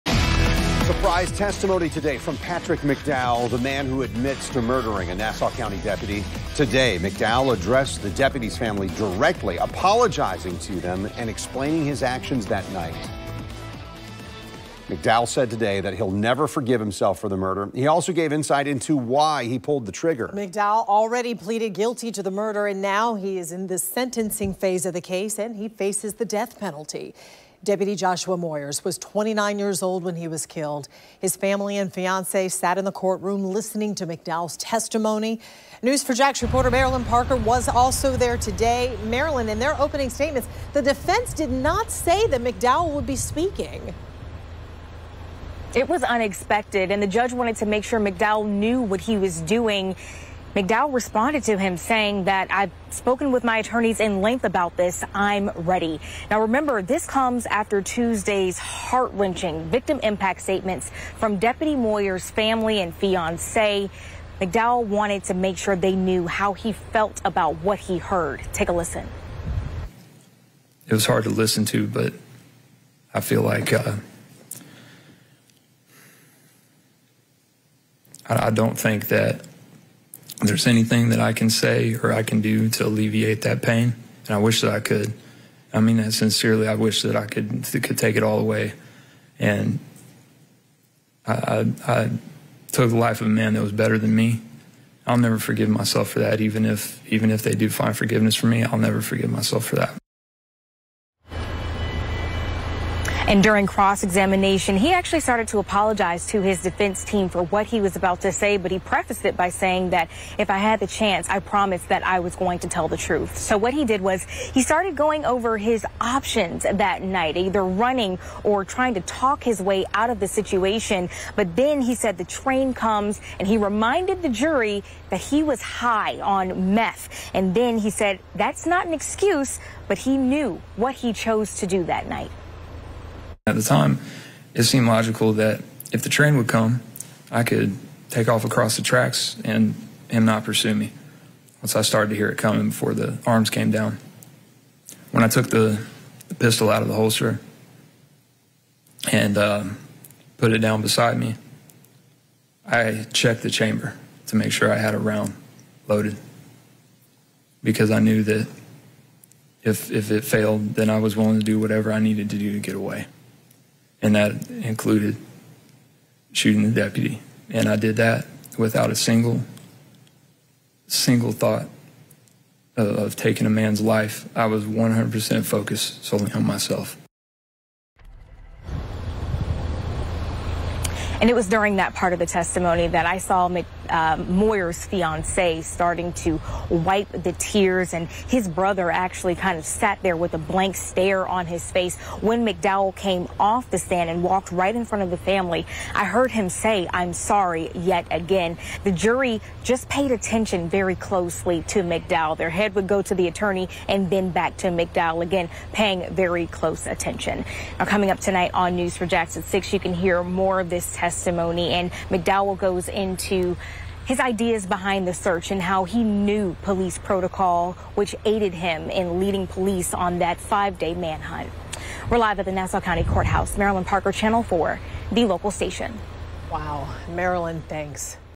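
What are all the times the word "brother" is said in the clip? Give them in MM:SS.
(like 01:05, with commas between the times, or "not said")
03:08.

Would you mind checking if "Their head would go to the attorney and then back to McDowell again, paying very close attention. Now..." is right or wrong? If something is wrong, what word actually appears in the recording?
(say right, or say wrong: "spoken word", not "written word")
right.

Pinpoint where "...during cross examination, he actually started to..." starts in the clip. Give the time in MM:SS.
01:43.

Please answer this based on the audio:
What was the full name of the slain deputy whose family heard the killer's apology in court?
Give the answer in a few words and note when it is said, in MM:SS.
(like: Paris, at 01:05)
Joshua Moyers, at 00:27.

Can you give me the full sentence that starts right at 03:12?
When McDowell came off the stand and walked right in front of the family, I heard him say, I'm sorry yet again.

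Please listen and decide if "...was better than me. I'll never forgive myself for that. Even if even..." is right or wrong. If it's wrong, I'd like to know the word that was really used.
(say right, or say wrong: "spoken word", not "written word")
right.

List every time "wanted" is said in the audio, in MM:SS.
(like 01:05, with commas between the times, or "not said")
00:47, 01:04.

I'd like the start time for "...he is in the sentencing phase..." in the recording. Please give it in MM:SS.
00:23.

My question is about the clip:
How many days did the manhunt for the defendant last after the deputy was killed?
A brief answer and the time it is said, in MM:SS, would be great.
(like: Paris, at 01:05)
5, at 03:40.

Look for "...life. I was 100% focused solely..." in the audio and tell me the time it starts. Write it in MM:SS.
02:53.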